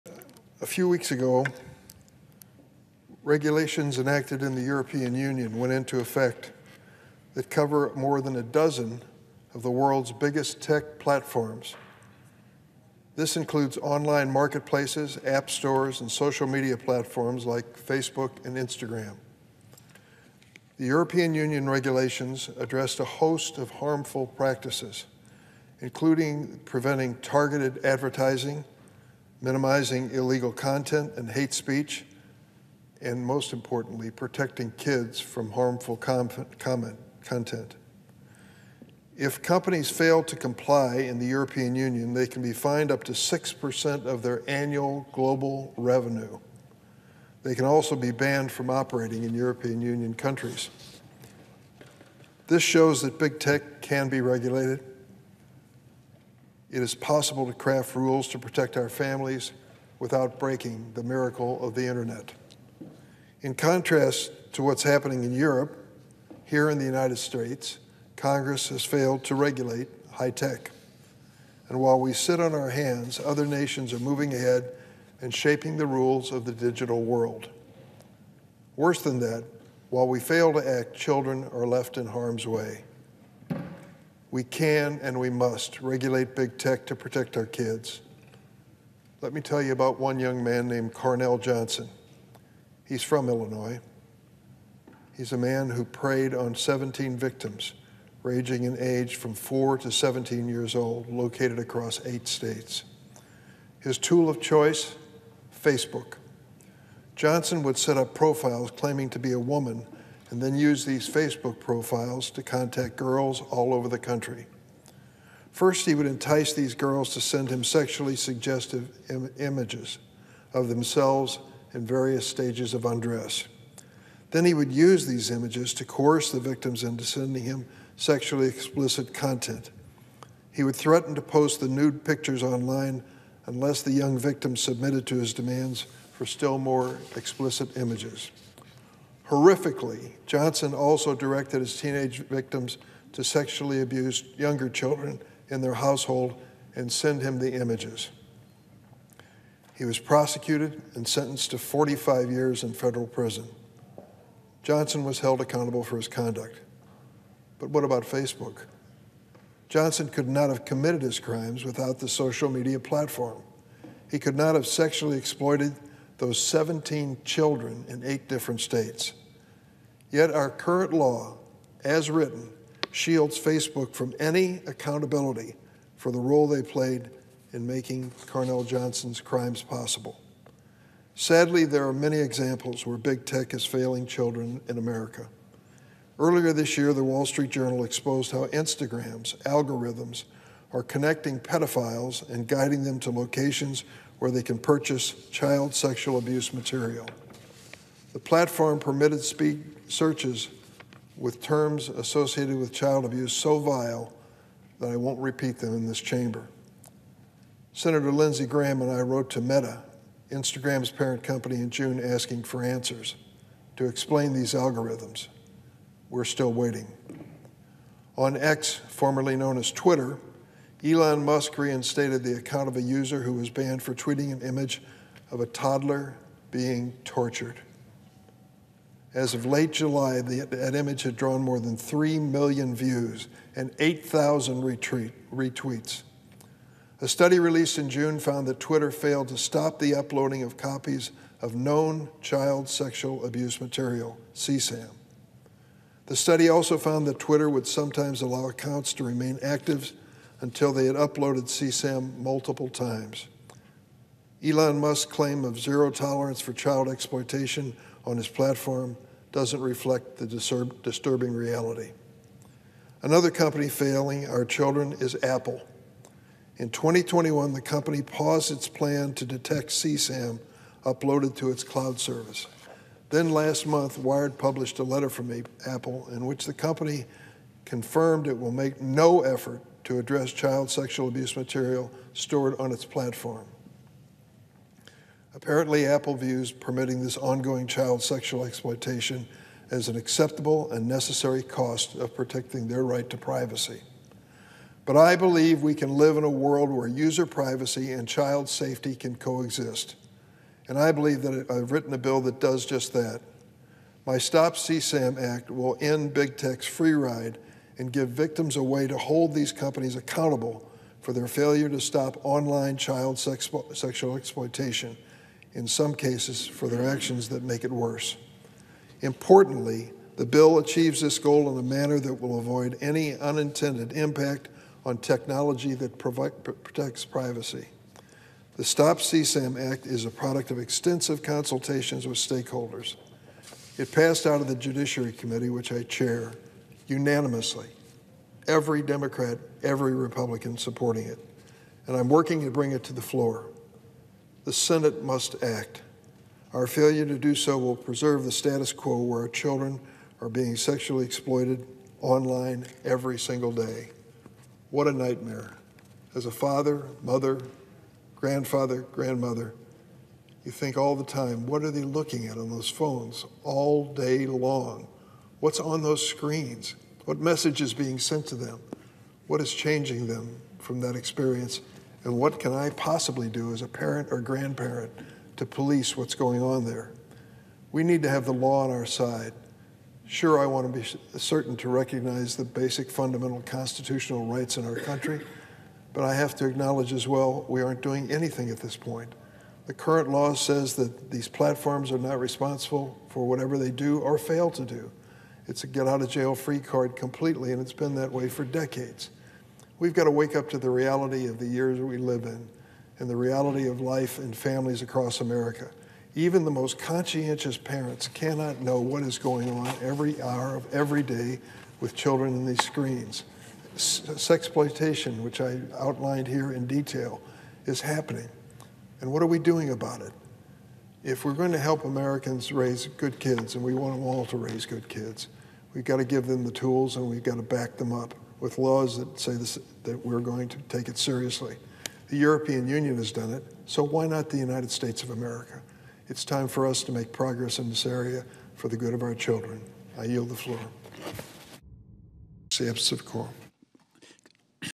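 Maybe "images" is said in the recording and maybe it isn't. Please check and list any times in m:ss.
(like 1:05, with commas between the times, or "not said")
1:59, 2:05, 2:17, 2:27, 3:44, 3:50.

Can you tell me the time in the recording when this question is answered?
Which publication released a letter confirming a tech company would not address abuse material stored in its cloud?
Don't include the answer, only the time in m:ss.
4:33.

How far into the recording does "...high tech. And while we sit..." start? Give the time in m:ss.
1:10.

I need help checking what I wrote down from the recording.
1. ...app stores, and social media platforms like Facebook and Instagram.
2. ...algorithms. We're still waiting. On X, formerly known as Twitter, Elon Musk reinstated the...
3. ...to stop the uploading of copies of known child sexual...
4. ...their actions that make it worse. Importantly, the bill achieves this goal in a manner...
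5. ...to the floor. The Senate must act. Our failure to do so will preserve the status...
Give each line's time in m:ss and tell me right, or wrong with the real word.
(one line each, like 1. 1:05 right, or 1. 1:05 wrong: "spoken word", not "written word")
1. 0:15 right
2. 3:34 right
3. 3:59 right
4. 5:16 right
5. 5:42 right.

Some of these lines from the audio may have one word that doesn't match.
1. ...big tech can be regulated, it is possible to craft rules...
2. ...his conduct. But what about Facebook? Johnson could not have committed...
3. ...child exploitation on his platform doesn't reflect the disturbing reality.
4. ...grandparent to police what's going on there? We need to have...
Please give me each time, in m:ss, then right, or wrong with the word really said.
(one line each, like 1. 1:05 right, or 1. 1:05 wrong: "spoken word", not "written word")
1. 0:53 right
2. 2:35 right
3. 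4:16 right
4. 6:14 right.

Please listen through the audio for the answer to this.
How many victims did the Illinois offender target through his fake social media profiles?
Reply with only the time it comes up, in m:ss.
1:36.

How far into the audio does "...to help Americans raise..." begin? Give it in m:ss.
7:01.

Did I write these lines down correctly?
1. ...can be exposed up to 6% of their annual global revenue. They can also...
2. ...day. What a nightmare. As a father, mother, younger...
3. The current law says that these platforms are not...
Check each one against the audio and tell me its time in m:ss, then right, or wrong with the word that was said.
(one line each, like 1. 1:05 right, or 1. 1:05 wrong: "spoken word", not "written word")
1. 0:42 wrong: "fined", not "exposed"
2. 5:53 wrong: "grandfather", not "younger"
3. 6:29 right.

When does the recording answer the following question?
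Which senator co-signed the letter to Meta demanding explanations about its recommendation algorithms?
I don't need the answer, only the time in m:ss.
3:28.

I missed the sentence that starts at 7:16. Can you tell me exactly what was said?
It's time for us to make progress in this area for the good of our children.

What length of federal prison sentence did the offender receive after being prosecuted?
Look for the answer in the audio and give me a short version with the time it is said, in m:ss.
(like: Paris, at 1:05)
45 years, at 2:31.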